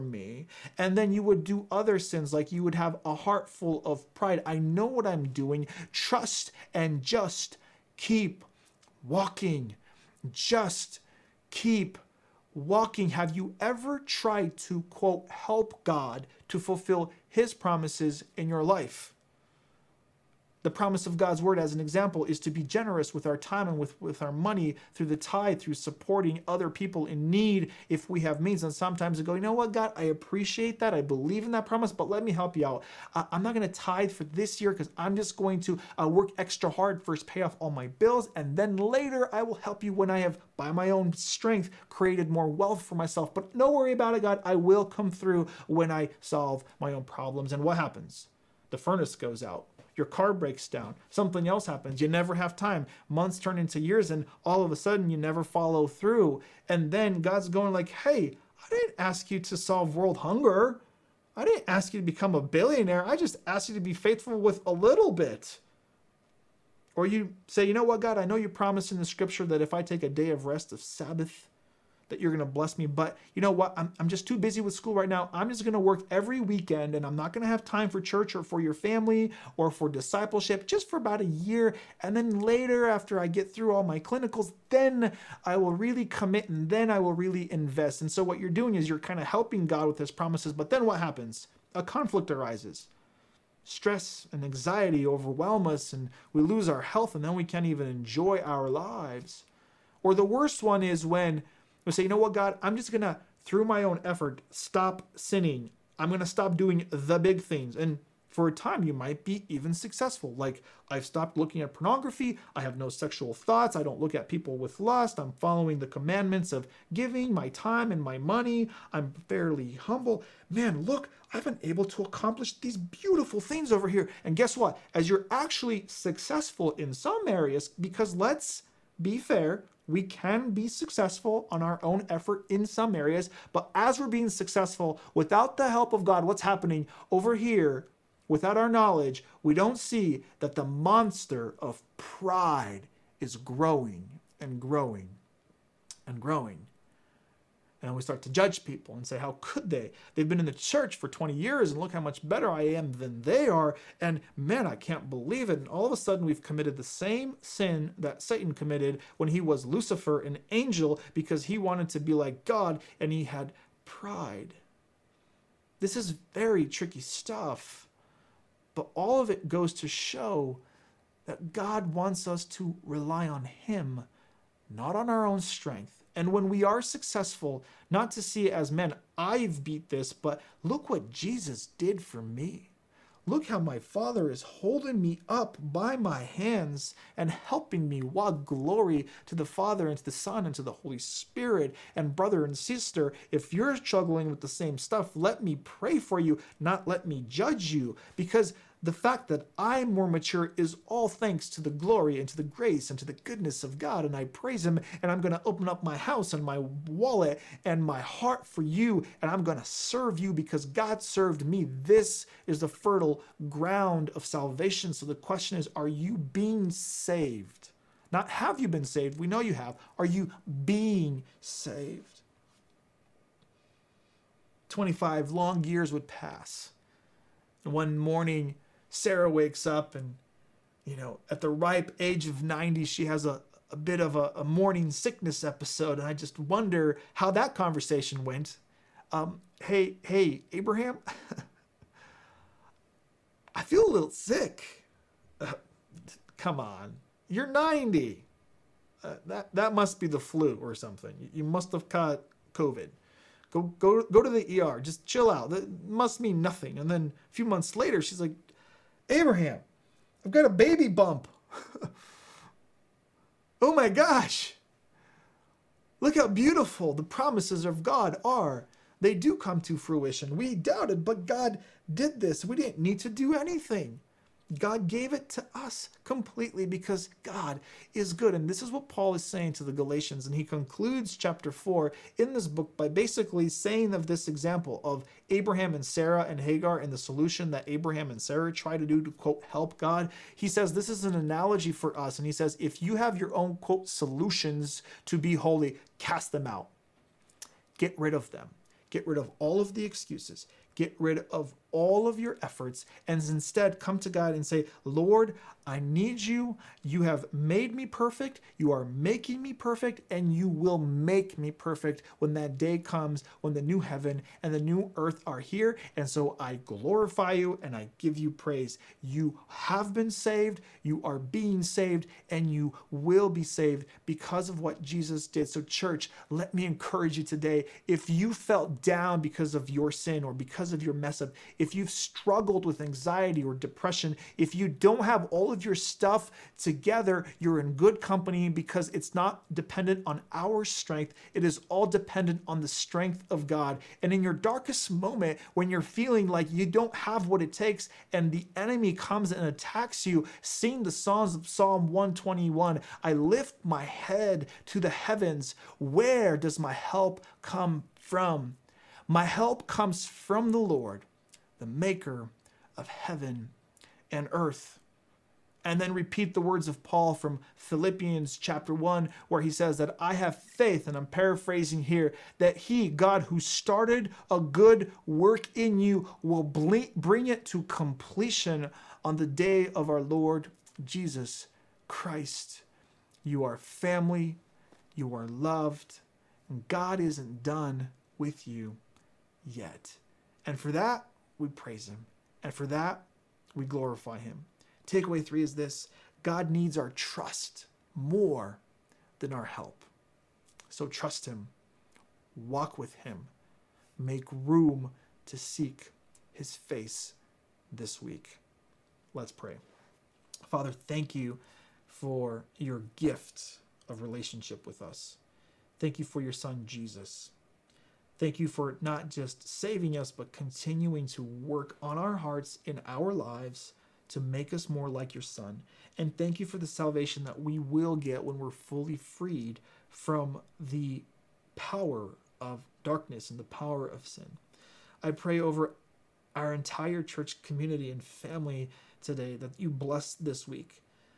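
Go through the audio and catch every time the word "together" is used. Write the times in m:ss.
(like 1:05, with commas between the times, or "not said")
5:36.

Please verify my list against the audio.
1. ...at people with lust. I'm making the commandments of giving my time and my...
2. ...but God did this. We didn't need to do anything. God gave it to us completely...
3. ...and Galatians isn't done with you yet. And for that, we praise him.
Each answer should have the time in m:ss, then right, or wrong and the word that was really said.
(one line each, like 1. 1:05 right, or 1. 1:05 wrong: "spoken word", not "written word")
1. 1:54 wrong: "following", not "making"
2. 4:31 right
3. 6:26 wrong: "God", not "Galatians".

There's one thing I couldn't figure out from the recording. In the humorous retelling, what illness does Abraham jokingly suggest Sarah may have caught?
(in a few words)
COVID.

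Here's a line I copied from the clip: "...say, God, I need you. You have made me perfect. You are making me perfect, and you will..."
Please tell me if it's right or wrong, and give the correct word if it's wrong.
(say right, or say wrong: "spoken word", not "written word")
wrong: "Lord", not "God".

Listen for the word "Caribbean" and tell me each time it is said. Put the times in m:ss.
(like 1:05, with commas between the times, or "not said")
not said.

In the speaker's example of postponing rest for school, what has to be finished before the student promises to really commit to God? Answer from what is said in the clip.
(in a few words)
clinicals.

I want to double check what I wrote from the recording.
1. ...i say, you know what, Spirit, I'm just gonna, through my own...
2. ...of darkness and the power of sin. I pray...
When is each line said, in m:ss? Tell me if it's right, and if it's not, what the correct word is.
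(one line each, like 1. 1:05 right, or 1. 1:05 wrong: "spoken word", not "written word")
1. 1:41 wrong: "God", not "Spirit"
2. 7:12 right.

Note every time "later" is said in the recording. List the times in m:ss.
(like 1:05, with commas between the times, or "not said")
0:38, 1:22, 4:17.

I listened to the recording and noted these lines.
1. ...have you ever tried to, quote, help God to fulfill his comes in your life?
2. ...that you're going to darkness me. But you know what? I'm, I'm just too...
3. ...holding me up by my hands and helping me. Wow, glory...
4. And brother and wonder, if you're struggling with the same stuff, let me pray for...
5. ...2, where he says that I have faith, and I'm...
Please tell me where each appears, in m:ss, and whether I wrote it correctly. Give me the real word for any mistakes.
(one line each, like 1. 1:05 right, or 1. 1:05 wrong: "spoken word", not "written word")
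1. 0:13 wrong: "promises", not "comes"
2. 1:12 wrong: "bless", not "darkness"
3. 3:04 right
4. 3:11 wrong: "sister", not "wonder"
5. 6:08 wrong: "1", not "2".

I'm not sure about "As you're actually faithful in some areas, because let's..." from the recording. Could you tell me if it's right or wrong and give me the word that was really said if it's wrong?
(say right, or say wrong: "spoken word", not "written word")
wrong: "successful", not "faithful".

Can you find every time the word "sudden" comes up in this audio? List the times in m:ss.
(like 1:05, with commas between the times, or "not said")
0:54, 2:35.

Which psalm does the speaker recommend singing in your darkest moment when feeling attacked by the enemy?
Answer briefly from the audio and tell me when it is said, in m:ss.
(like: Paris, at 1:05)
Psalm 121, at 5:51.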